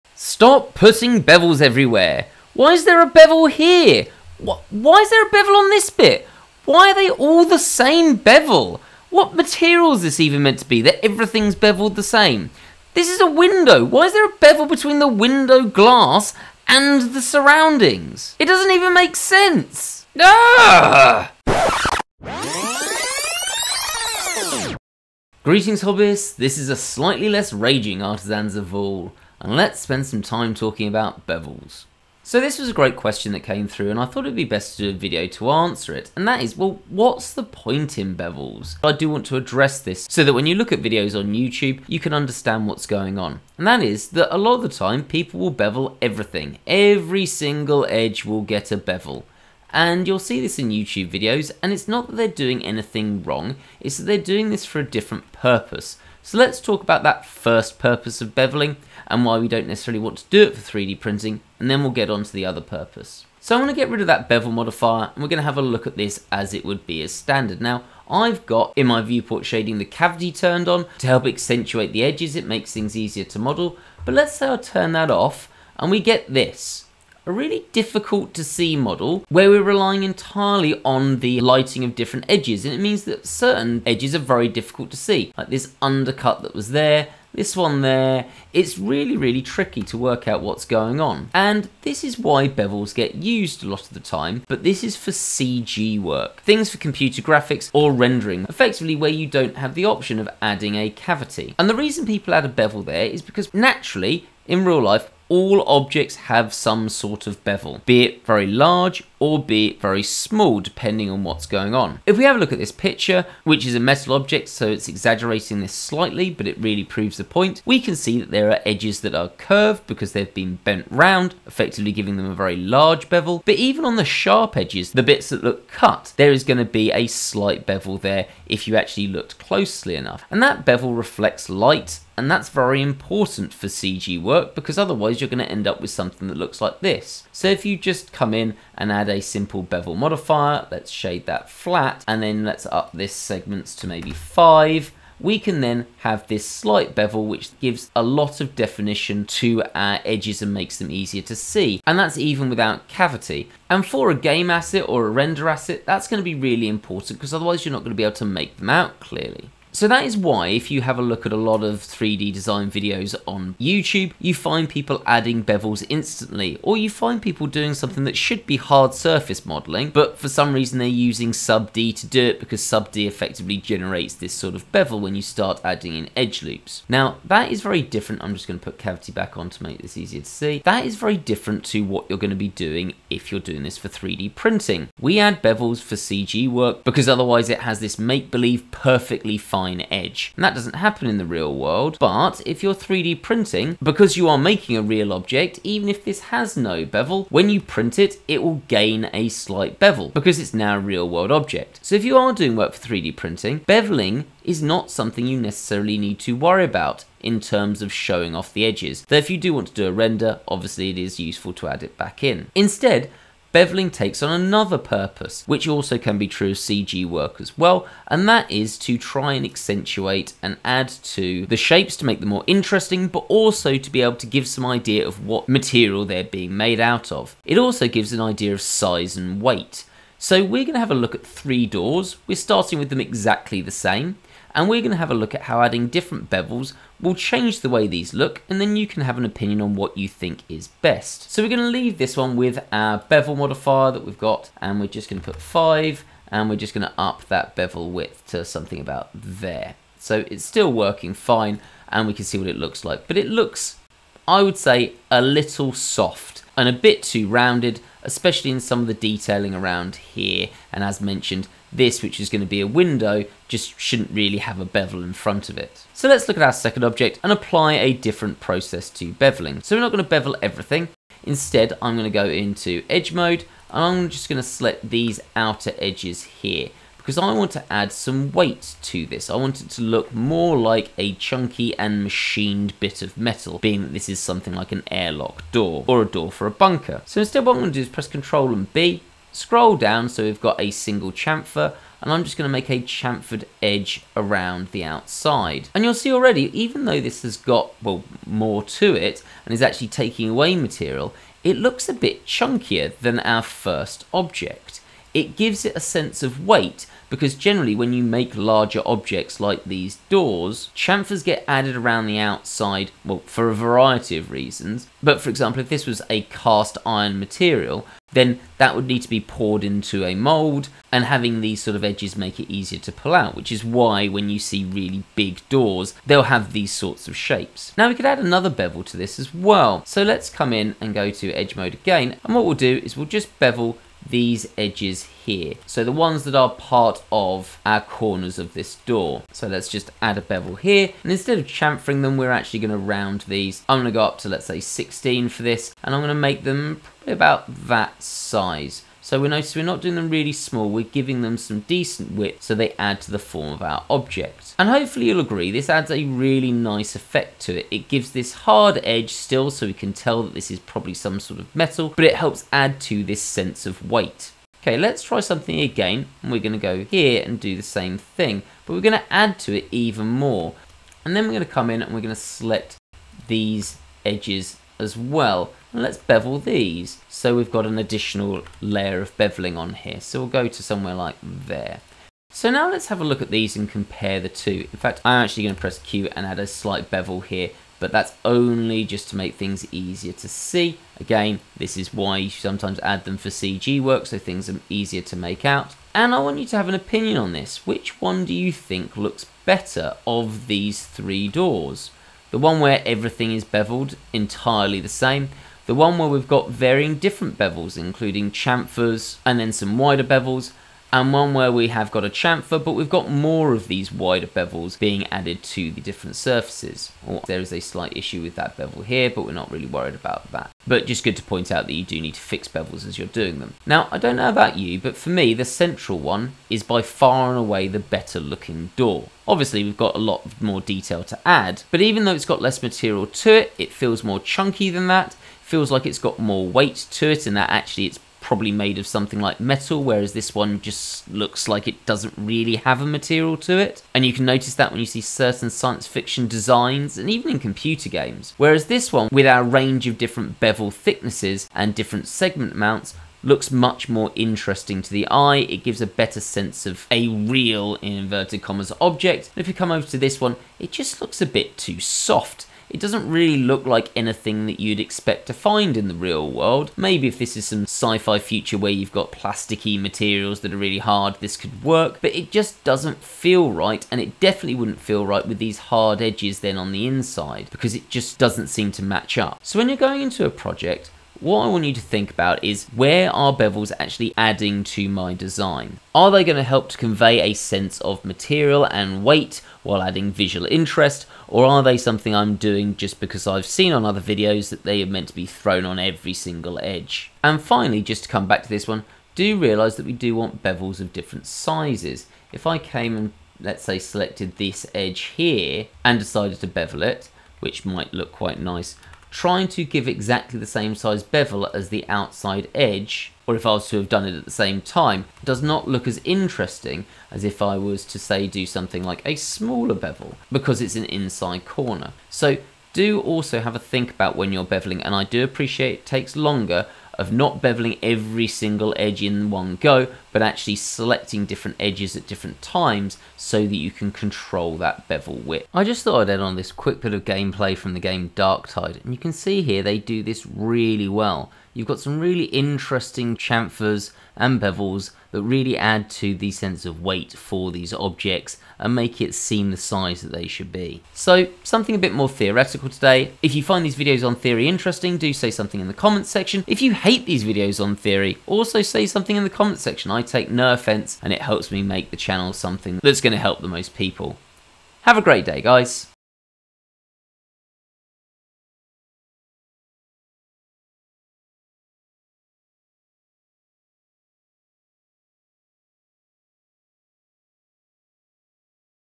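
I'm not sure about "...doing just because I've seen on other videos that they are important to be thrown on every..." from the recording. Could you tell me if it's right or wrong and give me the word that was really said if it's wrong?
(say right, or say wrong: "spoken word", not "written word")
wrong: "meant", not "important".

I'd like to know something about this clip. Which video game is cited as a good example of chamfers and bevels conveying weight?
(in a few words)
Darktide.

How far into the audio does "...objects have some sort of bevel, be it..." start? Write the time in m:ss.
1:45.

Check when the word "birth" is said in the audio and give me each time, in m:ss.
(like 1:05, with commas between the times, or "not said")
not said.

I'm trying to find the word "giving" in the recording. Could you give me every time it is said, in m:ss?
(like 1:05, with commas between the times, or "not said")
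2:01, 5:50.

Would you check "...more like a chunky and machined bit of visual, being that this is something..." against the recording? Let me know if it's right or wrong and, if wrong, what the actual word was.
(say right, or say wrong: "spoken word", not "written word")
wrong: "metal", not "visual".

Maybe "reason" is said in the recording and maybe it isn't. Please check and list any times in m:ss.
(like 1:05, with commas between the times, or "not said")
1:41, 2:50, 5:14.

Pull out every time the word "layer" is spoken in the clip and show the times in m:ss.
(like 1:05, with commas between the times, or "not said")
6:18.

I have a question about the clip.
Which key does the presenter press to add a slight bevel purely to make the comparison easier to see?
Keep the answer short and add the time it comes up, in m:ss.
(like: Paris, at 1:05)
Q, at 6:25.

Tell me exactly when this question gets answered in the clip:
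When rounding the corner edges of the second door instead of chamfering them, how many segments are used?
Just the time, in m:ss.
5:44.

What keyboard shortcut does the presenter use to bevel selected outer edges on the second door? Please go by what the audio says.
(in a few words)
Ctrl and B.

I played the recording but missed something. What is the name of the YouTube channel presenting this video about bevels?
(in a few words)
Artisans of Vaul.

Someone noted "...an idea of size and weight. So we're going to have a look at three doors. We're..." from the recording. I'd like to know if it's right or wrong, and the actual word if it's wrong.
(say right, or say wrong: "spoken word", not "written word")
right.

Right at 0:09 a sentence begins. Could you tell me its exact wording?
What material is this even meant to be that everything's beveled the same?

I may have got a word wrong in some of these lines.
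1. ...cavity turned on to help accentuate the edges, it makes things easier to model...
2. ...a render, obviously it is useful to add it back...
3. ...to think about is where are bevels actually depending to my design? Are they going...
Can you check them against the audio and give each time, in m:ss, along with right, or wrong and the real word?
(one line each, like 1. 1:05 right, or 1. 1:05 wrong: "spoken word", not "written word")
1. 1:09 right
2. 3:29 right
3. 8:01 wrong: "adding", not "depending".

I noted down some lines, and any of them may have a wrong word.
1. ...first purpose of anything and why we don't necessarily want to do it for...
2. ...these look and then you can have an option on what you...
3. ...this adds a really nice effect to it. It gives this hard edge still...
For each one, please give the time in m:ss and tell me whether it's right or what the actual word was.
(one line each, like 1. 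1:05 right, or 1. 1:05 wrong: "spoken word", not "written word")
1. 0:57 wrong: "beveling", not "anything"
2. 3:57 wrong: "opinion", not "option"
3. 5:55 right.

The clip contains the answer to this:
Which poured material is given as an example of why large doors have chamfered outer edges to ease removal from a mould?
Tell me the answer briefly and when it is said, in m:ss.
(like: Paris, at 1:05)
cast iron, at 5:16.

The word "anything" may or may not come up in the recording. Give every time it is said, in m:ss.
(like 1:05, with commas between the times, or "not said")
0:52, 7:43.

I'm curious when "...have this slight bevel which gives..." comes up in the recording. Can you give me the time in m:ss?
2:26.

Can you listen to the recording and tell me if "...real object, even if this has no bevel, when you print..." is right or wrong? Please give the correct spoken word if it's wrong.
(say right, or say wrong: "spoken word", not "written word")
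right.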